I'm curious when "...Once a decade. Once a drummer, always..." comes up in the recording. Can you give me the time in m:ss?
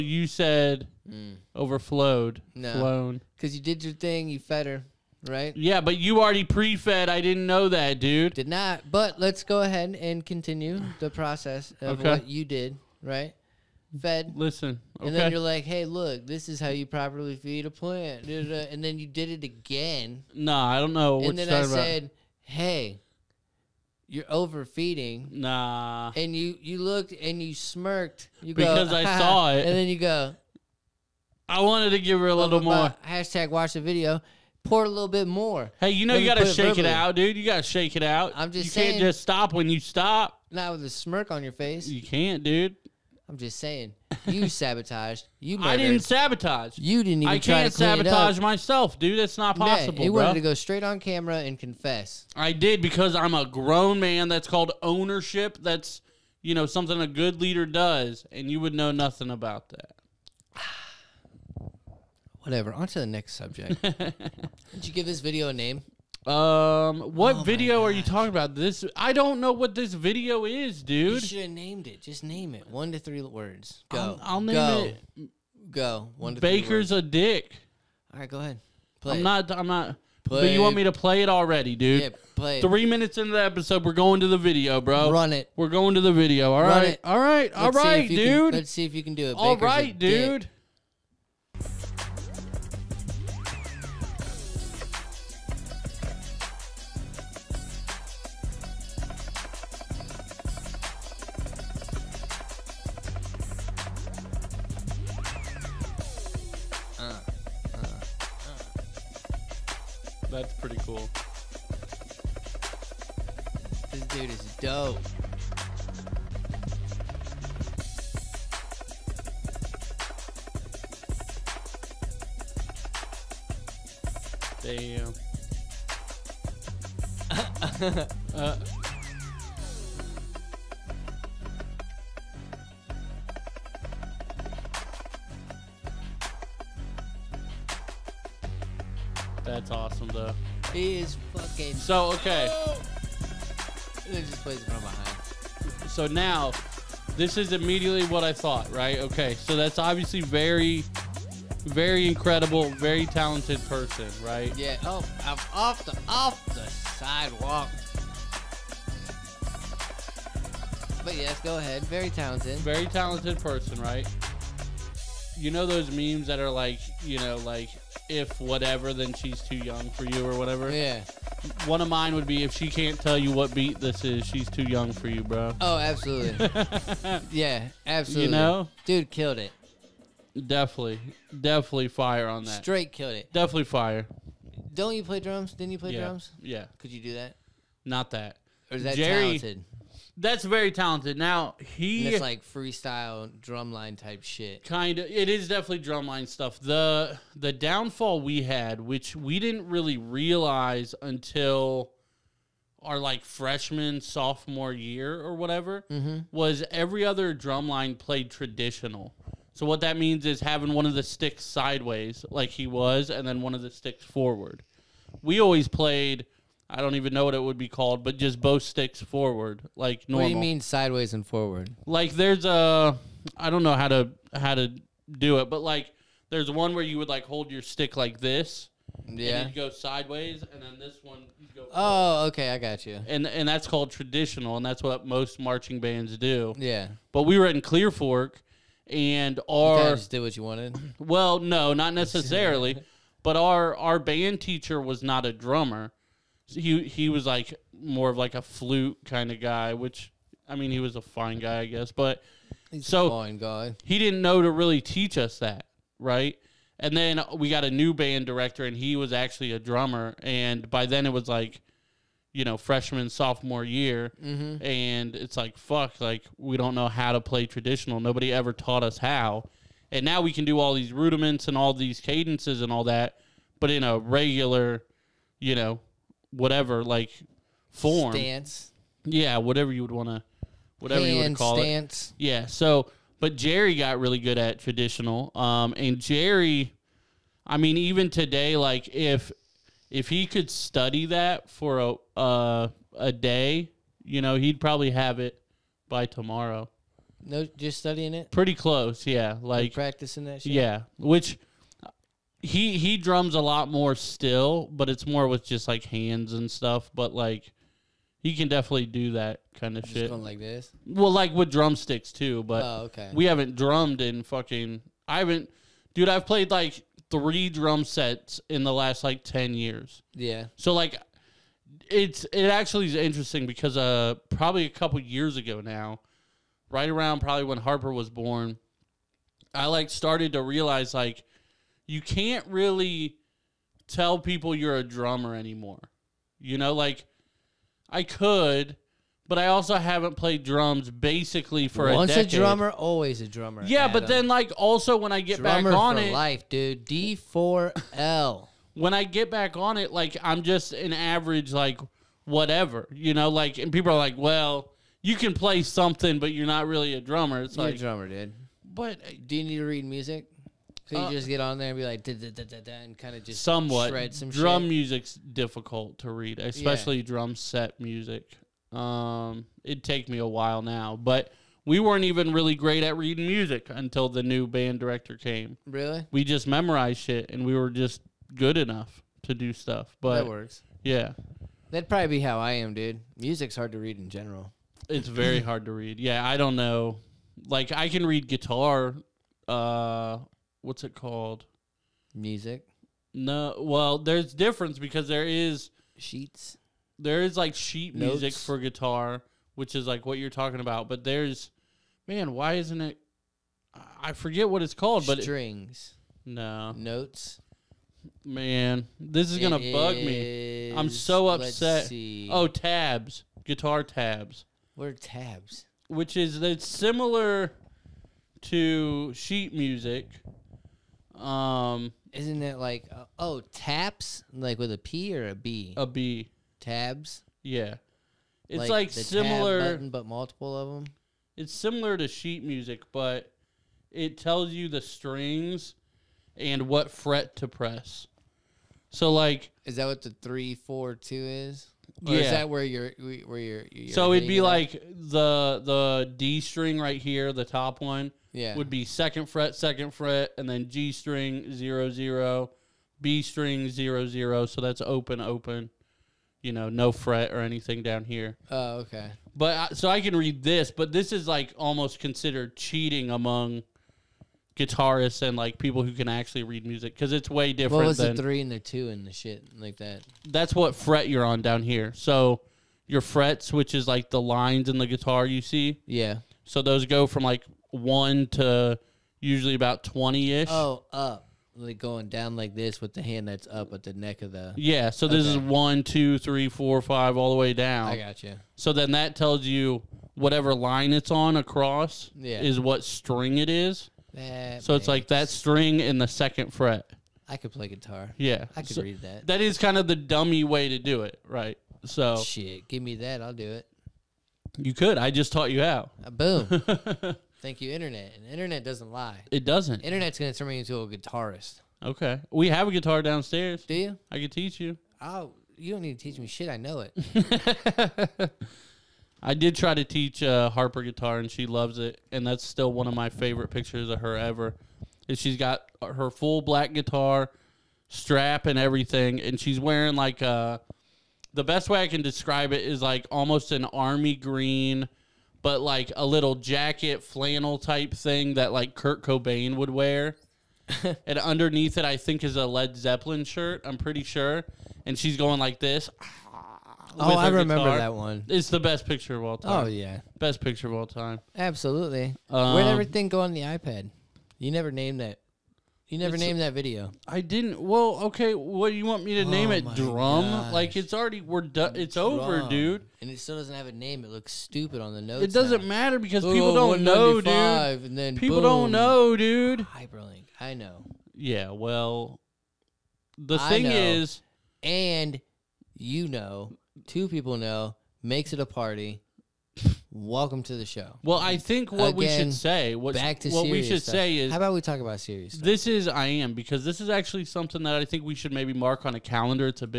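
5:41.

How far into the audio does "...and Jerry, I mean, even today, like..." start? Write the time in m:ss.
4:45.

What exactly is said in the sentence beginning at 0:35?
Hey, you know Let you gotta shake it, it, out, dude.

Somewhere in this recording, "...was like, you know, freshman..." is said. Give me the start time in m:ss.
4:21.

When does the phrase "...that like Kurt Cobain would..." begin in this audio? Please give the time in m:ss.
8:58.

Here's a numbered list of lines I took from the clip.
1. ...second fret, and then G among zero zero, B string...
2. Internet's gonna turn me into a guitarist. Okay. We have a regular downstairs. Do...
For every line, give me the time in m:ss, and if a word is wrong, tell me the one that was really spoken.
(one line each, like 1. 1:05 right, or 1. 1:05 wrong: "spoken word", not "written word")
1. 7:29 wrong: "string", not "among"
2. 8:29 wrong: "guitar", not "regular".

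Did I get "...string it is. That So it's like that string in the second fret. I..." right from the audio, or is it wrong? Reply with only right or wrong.
right.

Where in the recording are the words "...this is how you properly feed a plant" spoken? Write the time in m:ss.
0:16.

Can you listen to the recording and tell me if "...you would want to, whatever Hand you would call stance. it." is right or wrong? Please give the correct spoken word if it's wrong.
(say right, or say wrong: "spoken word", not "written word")
right.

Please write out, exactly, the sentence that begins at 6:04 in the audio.
music's difficult to read, especially yeah.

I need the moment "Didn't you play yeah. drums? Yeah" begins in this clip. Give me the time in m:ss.
3:05.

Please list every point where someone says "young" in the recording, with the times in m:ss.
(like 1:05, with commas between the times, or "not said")
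2:49, 2:54.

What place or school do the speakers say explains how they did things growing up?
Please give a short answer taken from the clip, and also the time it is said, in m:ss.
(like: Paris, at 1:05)
Clear Fork, at 3:57.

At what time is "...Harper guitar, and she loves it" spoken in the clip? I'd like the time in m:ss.
8:40.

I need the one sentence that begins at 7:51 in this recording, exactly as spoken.
So your frets, which is like the lines in the guitar you see.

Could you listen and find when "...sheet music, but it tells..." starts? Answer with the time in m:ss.
7:12.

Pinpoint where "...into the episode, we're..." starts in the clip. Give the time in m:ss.
1:23.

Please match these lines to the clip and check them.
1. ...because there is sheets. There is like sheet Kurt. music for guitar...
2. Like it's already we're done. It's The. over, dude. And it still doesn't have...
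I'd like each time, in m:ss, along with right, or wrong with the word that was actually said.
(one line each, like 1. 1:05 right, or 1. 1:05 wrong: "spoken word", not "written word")
1. 6:34 wrong: "Notes", not "Kurt"
2. 9:20 wrong: "Drum", not "The".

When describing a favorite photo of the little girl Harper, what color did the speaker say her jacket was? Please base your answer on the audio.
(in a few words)
army green.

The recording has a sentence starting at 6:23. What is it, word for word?
Music's hard to read in general.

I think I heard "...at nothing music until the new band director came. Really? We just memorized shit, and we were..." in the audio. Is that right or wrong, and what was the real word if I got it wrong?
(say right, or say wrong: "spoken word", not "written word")
wrong: "reading", not "nothing".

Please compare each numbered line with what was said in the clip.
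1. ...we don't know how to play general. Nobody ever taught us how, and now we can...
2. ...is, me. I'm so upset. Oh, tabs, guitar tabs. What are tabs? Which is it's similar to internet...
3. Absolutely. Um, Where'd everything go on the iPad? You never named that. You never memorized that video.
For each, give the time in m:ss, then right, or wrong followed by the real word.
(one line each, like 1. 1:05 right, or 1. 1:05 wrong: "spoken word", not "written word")
1. 4:26 wrong: "traditional", not "general"
2. 6:49 wrong: "sheet", not "internet"
3. 9:11 wrong: "named", not "memorized".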